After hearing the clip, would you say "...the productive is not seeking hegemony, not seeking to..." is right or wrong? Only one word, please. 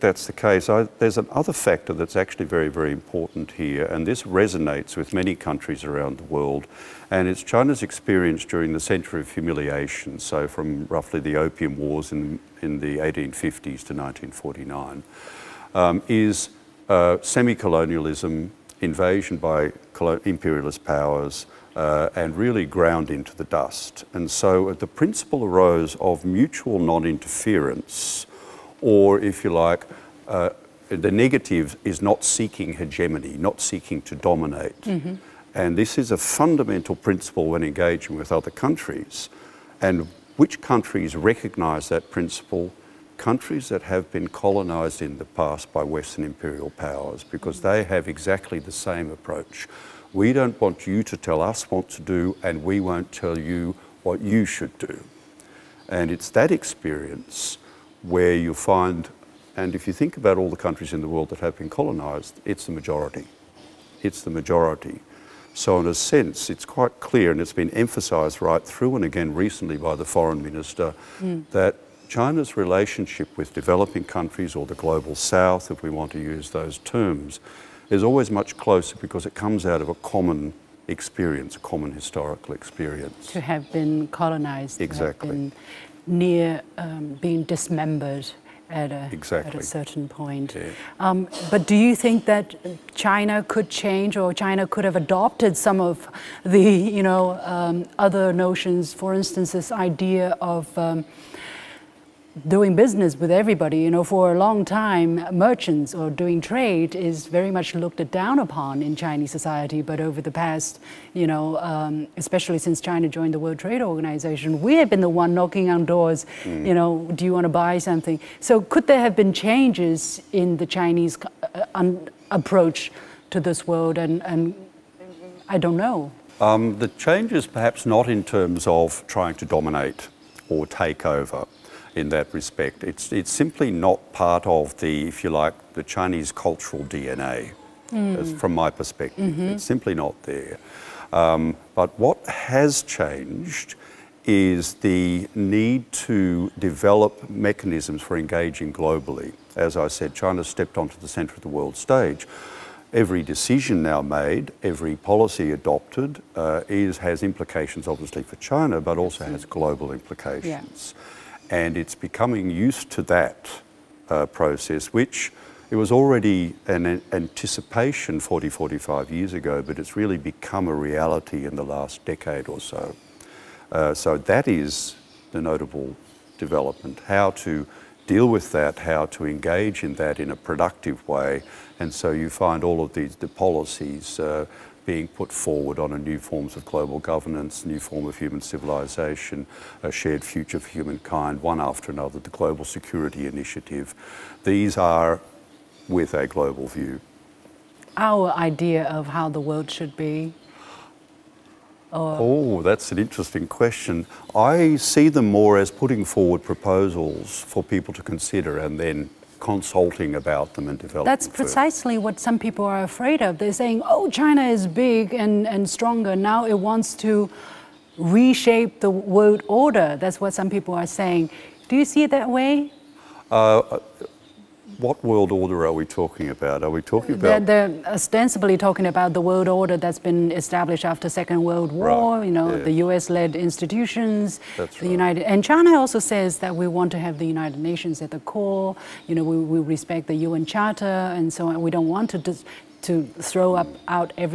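wrong.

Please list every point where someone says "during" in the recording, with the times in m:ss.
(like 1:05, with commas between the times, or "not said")
0:08.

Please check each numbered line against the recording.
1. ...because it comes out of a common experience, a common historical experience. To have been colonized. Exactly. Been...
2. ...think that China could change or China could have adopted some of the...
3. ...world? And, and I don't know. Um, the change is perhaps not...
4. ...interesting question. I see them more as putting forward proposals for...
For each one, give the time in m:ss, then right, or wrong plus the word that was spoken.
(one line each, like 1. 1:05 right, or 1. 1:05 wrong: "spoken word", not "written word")
1. 1:18 right
2. 1:31 right
3. 2:03 right
4. 3:22 right.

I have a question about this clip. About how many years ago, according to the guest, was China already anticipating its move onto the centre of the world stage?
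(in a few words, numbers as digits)
45 years.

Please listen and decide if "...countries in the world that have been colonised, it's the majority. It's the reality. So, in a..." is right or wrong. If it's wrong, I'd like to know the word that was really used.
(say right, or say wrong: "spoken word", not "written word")
wrong: "majority", not "reality".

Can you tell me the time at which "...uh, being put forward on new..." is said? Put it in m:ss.
3:04.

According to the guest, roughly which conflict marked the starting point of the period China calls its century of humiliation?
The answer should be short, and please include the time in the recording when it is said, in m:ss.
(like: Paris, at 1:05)
Opium Wars, at 0:11.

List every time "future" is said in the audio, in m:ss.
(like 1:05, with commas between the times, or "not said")
3:10.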